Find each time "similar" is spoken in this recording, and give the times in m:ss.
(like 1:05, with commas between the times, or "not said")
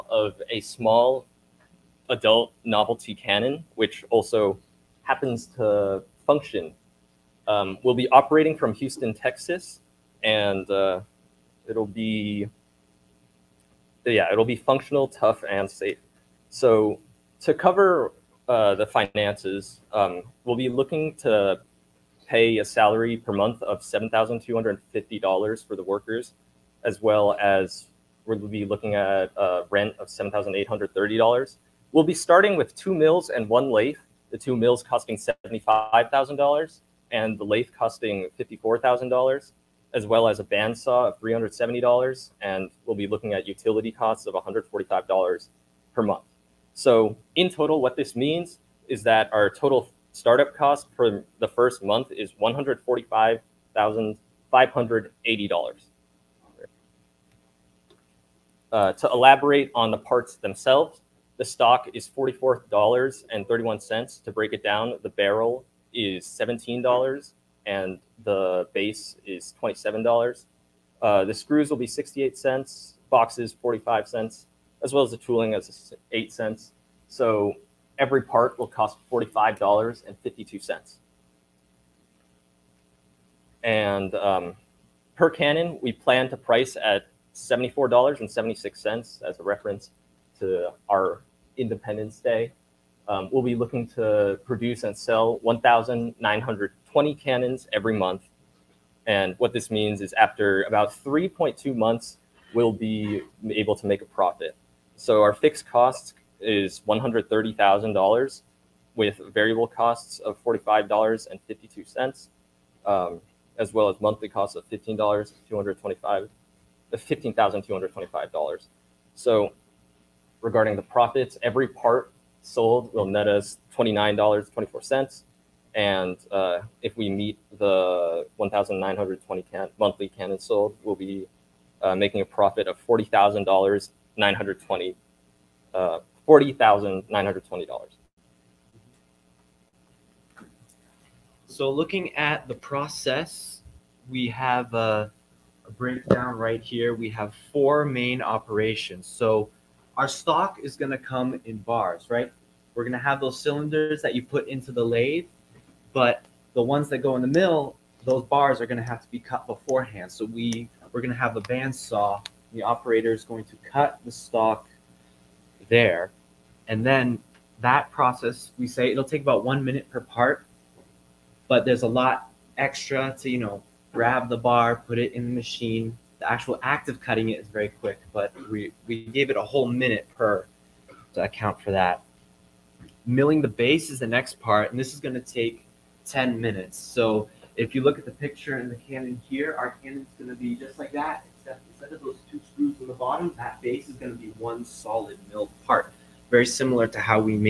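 3:16.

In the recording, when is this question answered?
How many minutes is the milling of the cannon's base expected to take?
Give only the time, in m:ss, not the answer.
3:06.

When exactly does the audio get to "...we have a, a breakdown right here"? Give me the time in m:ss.
2:24.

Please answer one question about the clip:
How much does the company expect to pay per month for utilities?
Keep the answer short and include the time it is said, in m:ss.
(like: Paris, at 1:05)
$145, at 0:44.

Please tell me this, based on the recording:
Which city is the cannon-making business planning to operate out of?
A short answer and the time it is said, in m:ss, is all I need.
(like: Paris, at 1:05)
Houston, at 0:08.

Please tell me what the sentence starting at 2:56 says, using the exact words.
The actual act of cutting it is very quick, but we, we gave it a whole minute per to account for that.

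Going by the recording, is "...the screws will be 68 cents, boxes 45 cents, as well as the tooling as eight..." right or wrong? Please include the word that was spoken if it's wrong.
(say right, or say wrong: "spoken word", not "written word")
right.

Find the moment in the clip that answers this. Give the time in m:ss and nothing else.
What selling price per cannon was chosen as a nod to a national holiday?
1:27.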